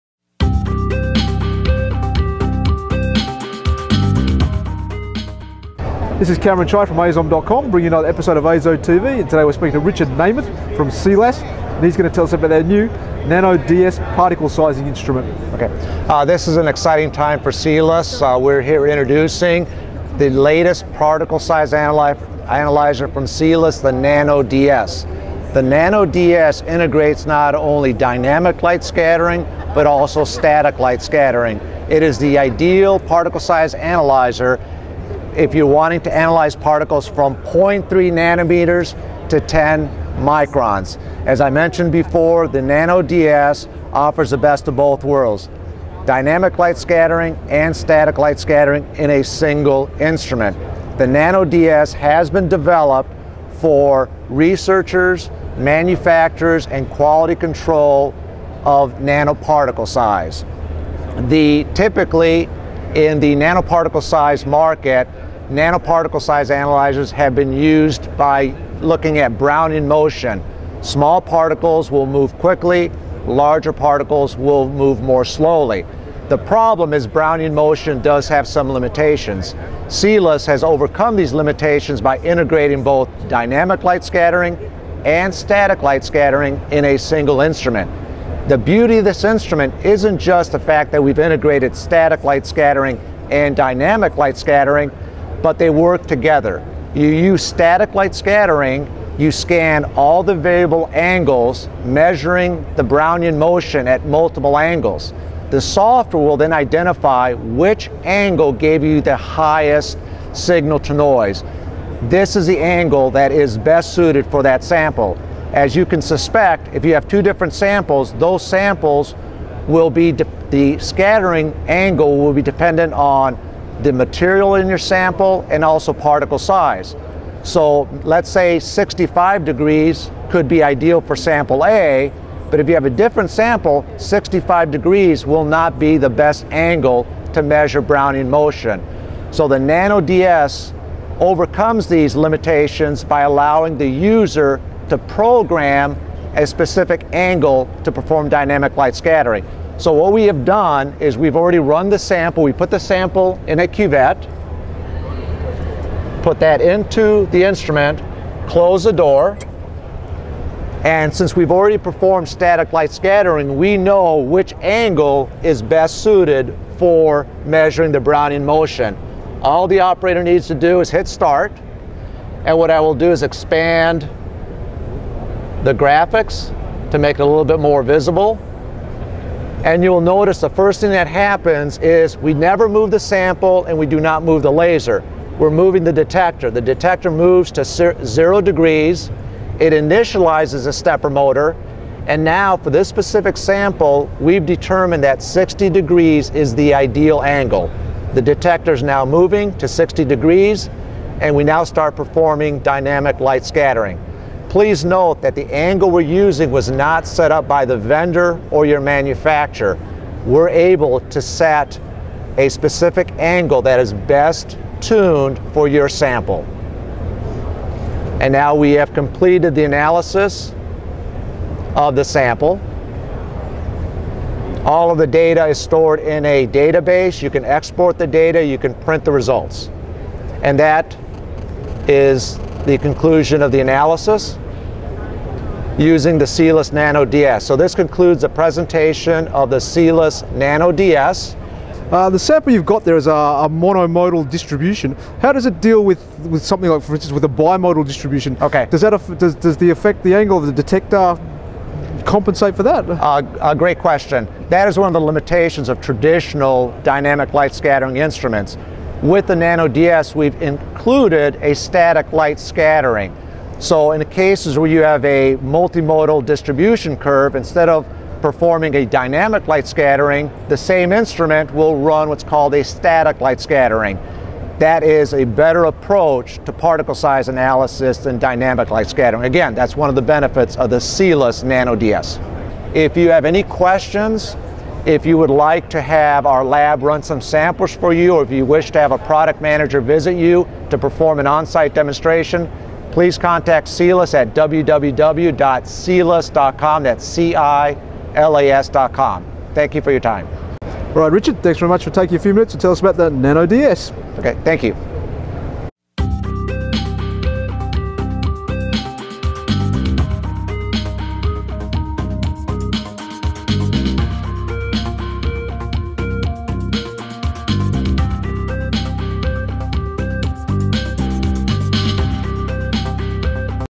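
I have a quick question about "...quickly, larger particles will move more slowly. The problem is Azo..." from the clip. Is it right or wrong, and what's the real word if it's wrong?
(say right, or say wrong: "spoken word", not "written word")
wrong: "Brownian", not "Azo".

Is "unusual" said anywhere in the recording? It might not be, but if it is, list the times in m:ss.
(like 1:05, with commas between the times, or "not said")
not said.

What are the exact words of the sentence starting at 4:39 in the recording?
Again, that's one of the benefits of the Cilas Nano DS.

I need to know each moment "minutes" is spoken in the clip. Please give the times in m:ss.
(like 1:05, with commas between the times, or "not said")
5:02.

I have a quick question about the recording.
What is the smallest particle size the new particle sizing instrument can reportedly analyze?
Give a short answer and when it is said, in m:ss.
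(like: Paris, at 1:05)
0.3 nanometers, at 0:37.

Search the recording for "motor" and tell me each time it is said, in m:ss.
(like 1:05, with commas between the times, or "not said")
3:11.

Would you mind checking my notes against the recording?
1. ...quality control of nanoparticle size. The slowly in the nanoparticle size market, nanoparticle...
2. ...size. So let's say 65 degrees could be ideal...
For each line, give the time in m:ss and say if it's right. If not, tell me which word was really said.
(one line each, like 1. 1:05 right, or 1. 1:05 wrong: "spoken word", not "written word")
1. 0:56 wrong: "typically", not "slowly"
2. 2:06 right.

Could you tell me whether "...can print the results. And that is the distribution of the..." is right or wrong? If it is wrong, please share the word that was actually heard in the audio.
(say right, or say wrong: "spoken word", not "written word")
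wrong: "conclusion", not "distribution".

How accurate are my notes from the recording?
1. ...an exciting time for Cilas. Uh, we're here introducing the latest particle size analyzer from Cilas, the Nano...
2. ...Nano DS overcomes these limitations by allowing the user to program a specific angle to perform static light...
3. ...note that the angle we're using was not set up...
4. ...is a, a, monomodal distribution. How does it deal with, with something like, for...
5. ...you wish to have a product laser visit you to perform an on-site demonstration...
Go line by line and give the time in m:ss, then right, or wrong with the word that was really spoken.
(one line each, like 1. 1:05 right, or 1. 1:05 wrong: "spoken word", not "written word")
1. 0:16 right
2. 2:19 wrong: "dynamic", not "static"
3. 3:24 right
4. 4:02 right
5. 4:48 wrong: "manager", not "laser".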